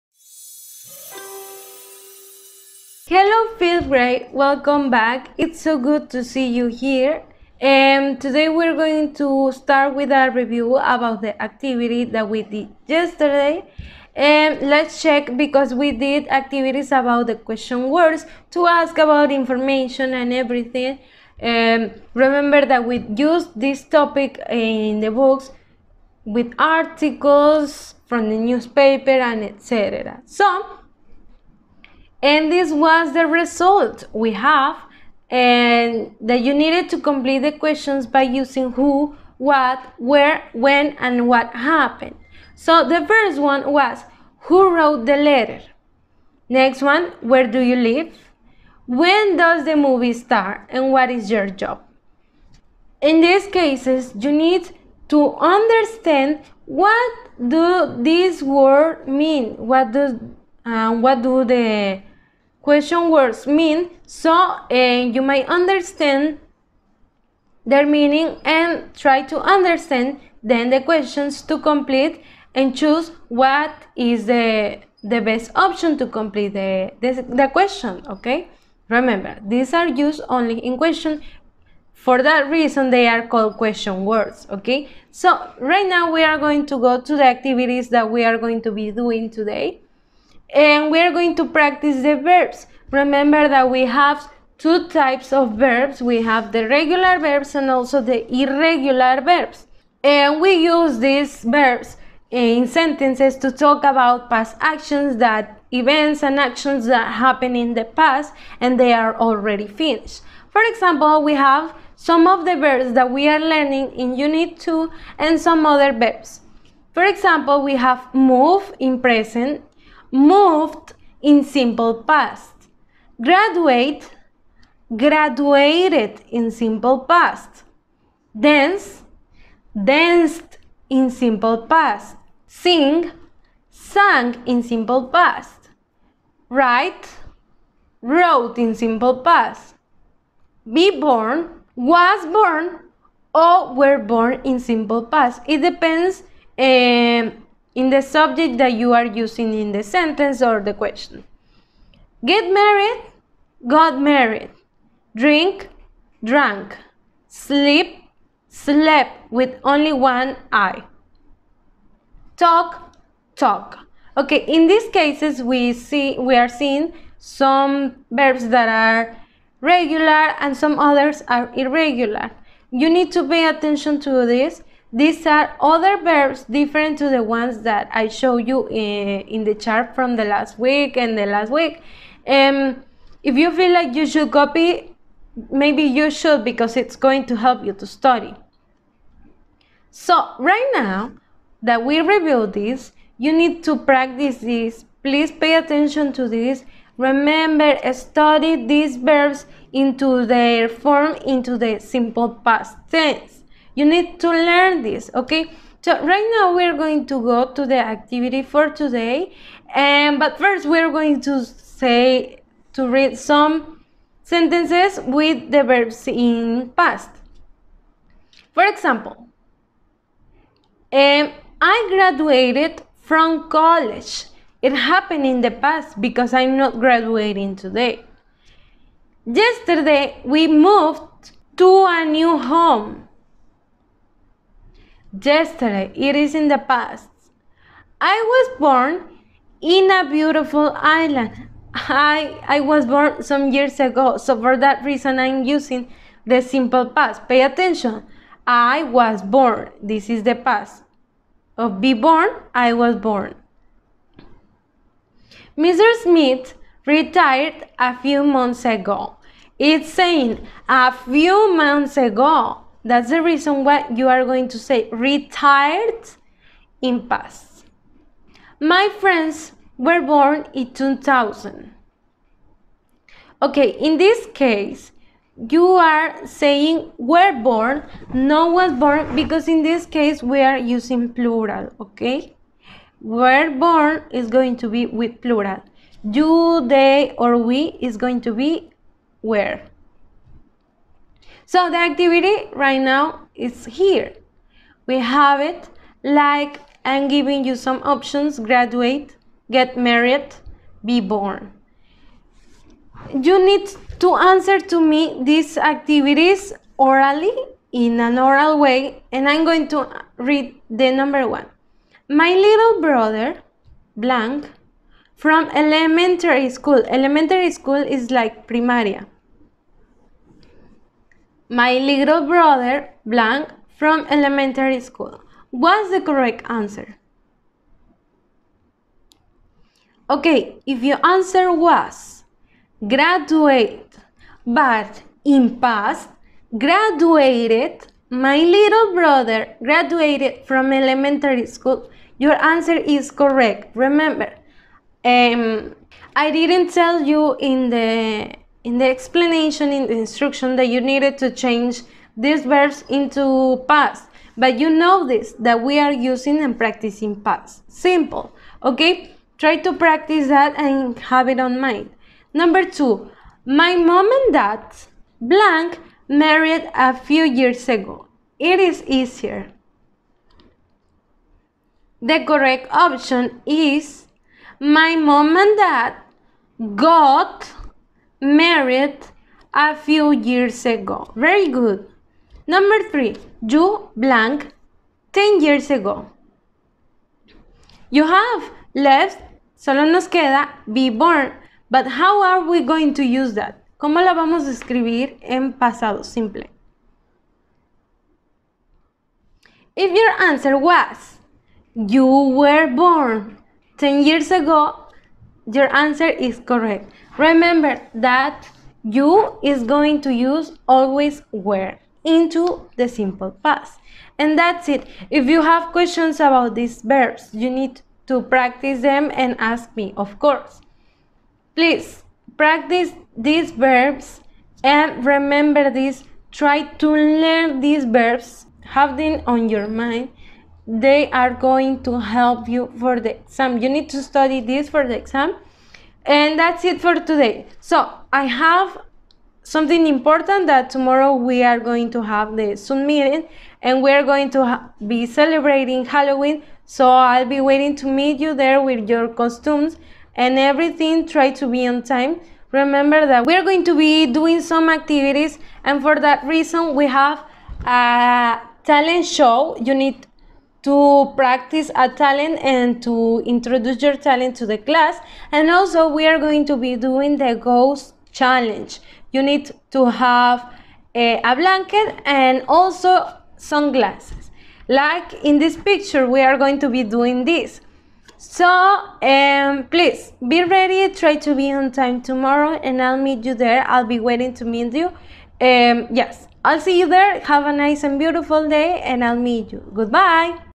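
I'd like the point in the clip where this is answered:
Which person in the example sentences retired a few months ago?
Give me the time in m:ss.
4:15.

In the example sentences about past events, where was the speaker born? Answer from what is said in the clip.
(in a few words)
a beautiful island.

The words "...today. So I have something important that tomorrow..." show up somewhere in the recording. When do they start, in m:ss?
7:16.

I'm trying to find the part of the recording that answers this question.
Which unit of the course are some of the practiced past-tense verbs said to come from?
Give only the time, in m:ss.
1:54.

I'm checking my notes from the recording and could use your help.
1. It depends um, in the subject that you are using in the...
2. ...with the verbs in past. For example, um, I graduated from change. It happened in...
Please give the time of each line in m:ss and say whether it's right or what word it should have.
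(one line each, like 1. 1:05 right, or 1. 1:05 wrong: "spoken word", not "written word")
1. 2:25 right
2. 3:35 wrong: "college", not "change".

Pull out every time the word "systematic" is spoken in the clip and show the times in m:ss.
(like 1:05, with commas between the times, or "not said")
not said.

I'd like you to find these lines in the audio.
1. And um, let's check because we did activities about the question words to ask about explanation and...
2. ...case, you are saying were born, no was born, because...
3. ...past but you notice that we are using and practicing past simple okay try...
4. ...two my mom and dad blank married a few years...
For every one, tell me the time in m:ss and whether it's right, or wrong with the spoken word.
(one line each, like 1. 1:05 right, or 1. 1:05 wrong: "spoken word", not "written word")
1. 0:14 wrong: "information", not "explanation"
2. 4:34 right
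3. 5:53 right
4. 6:02 right.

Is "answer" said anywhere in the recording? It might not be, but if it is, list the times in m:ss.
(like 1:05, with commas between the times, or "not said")
5:04, 5:26, 5:31, 5:42, 6:40, 6:45.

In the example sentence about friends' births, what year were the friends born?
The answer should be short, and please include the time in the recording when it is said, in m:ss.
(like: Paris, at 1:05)
2000, at 4:30.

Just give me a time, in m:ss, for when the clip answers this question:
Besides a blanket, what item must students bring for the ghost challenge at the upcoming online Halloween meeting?
7:53.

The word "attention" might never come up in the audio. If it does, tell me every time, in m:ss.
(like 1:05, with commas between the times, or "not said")
2:53, 3:15, 4:07.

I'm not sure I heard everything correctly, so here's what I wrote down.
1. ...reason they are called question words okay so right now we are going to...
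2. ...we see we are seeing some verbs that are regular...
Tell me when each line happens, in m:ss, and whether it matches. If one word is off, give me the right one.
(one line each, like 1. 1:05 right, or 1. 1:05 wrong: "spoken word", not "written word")
1. 1:22 right
2. 2:45 right.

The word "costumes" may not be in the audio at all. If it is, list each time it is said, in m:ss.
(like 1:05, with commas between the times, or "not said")
7:29.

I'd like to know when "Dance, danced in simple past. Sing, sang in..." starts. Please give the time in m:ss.
2:08.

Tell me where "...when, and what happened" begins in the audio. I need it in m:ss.
0:40.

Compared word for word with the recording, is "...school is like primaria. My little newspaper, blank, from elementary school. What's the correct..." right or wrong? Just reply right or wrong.
wrong.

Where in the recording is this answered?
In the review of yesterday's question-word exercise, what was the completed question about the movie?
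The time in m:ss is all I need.
0:48.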